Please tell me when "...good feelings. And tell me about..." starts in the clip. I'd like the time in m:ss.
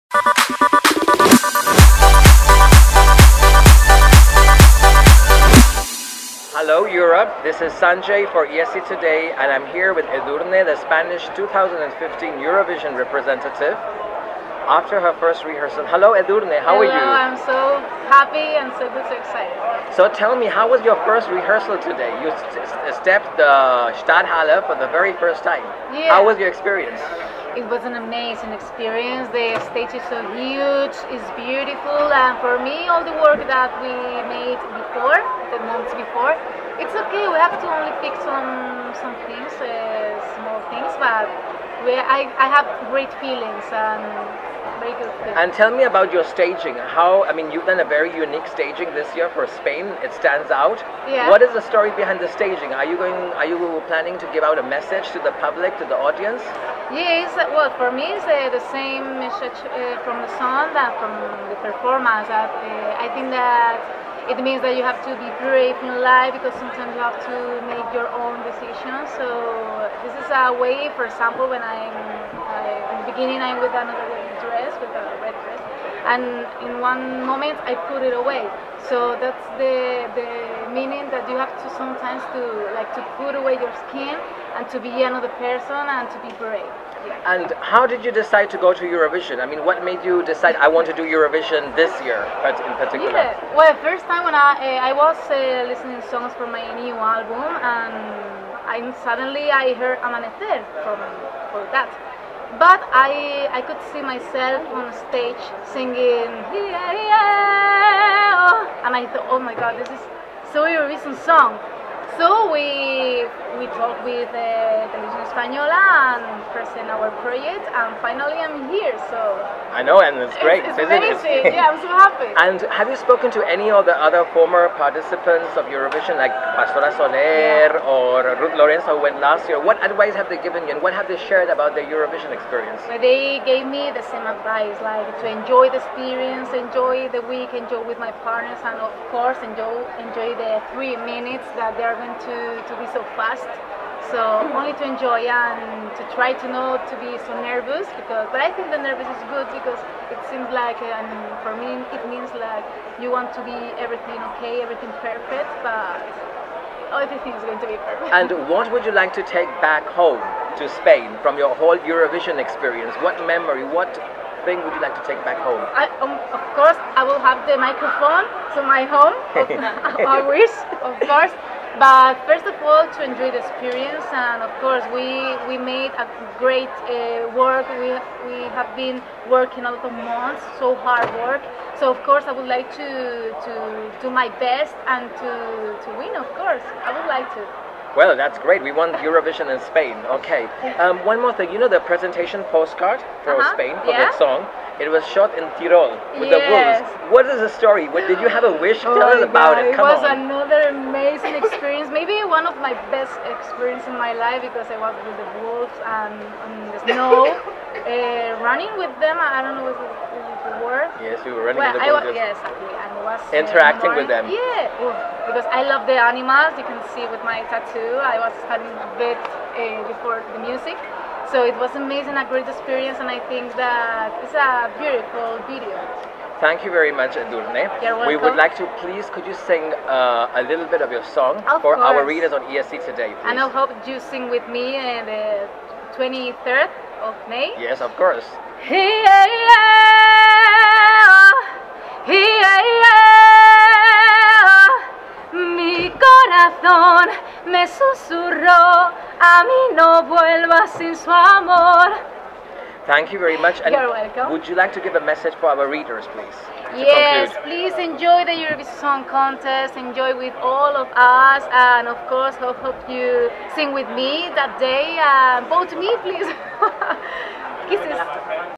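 0:44.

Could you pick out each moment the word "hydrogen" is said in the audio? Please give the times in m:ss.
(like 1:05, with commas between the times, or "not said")
not said.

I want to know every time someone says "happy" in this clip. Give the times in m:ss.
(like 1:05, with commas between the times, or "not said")
0:18, 2:01.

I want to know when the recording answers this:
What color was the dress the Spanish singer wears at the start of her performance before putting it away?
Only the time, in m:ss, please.
1:15.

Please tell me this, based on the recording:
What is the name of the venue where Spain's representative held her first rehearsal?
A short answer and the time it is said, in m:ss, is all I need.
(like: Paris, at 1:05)
Stadthalle, at 0:23.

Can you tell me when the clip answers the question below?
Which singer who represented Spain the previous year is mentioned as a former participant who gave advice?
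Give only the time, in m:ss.
2:08.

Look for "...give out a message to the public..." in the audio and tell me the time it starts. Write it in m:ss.
0:54.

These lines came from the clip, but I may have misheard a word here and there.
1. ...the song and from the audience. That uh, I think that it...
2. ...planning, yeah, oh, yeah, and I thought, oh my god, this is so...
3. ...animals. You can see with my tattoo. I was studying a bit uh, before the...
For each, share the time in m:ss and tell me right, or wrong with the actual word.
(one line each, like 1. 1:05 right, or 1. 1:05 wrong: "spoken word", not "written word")
1. 1:00 wrong: "performance", not "audience"
2. 1:45 wrong: "singing", not "planning"
3. 3:36 right.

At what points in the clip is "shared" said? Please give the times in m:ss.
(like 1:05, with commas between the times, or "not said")
2:11.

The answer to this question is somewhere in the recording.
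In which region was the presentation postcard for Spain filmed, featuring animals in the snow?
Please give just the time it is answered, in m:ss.
3:15.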